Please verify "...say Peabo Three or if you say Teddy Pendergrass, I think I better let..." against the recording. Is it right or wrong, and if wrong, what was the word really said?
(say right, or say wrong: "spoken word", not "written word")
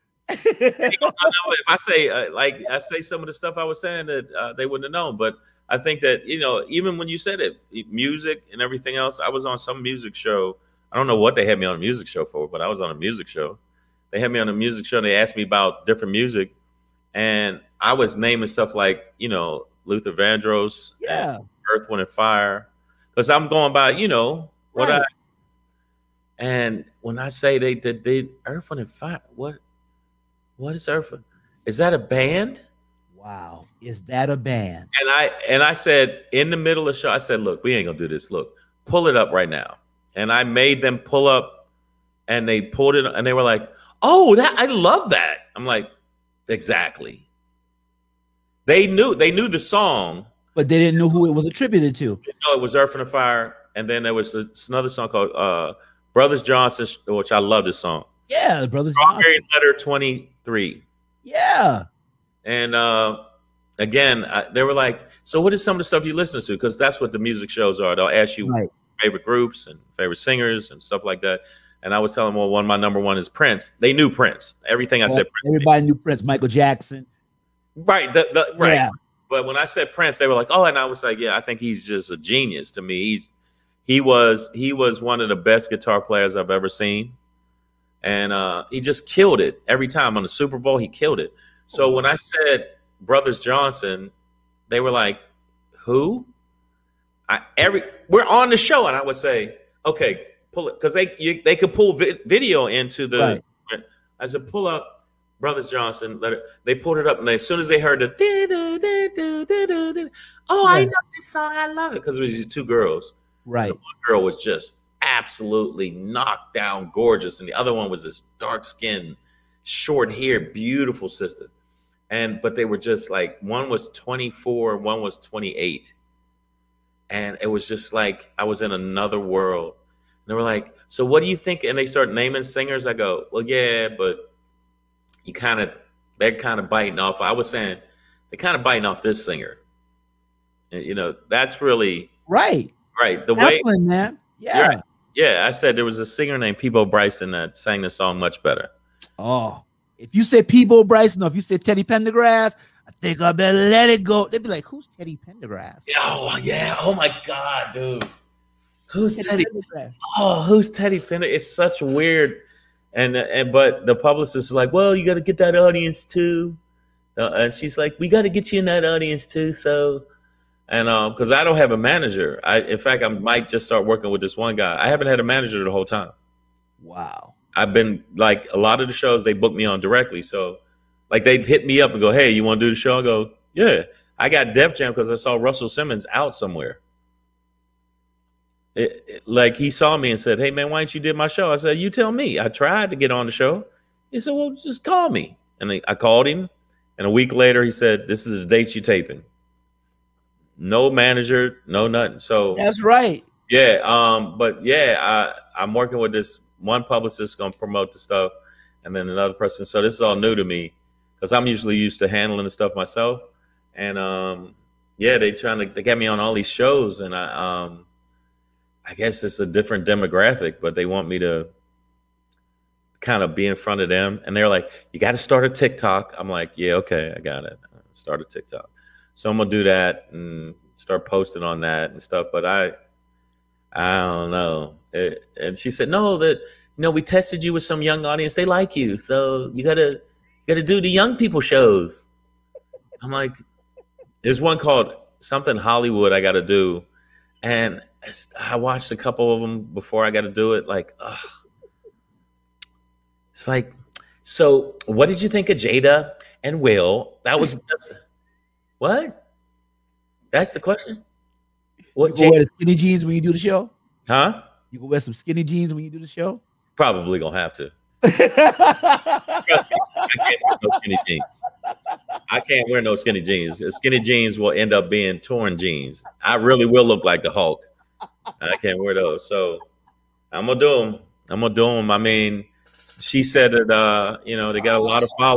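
wrong: "Bryson", not "Three".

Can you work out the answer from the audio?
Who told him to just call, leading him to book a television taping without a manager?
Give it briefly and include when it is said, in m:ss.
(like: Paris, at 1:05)
Russell Simmons, at 3:05.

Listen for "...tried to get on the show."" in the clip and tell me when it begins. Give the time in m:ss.
3:12.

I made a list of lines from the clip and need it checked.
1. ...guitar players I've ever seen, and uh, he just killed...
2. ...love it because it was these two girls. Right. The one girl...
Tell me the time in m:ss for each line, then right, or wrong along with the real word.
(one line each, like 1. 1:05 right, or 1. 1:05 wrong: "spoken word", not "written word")
1. 1:25 right
2. 1:51 right.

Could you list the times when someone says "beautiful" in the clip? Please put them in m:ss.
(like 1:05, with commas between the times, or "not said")
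2:00.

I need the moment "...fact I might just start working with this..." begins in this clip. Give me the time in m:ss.
2:52.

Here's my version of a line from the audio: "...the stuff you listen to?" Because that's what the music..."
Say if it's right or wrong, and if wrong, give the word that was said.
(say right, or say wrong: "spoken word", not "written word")
right.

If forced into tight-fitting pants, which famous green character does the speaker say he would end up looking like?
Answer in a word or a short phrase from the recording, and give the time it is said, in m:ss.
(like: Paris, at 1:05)
The Hulk, at 4:37.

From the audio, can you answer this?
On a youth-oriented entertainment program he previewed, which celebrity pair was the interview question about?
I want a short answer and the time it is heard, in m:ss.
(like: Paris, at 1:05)
Jada and Will, at 4:15.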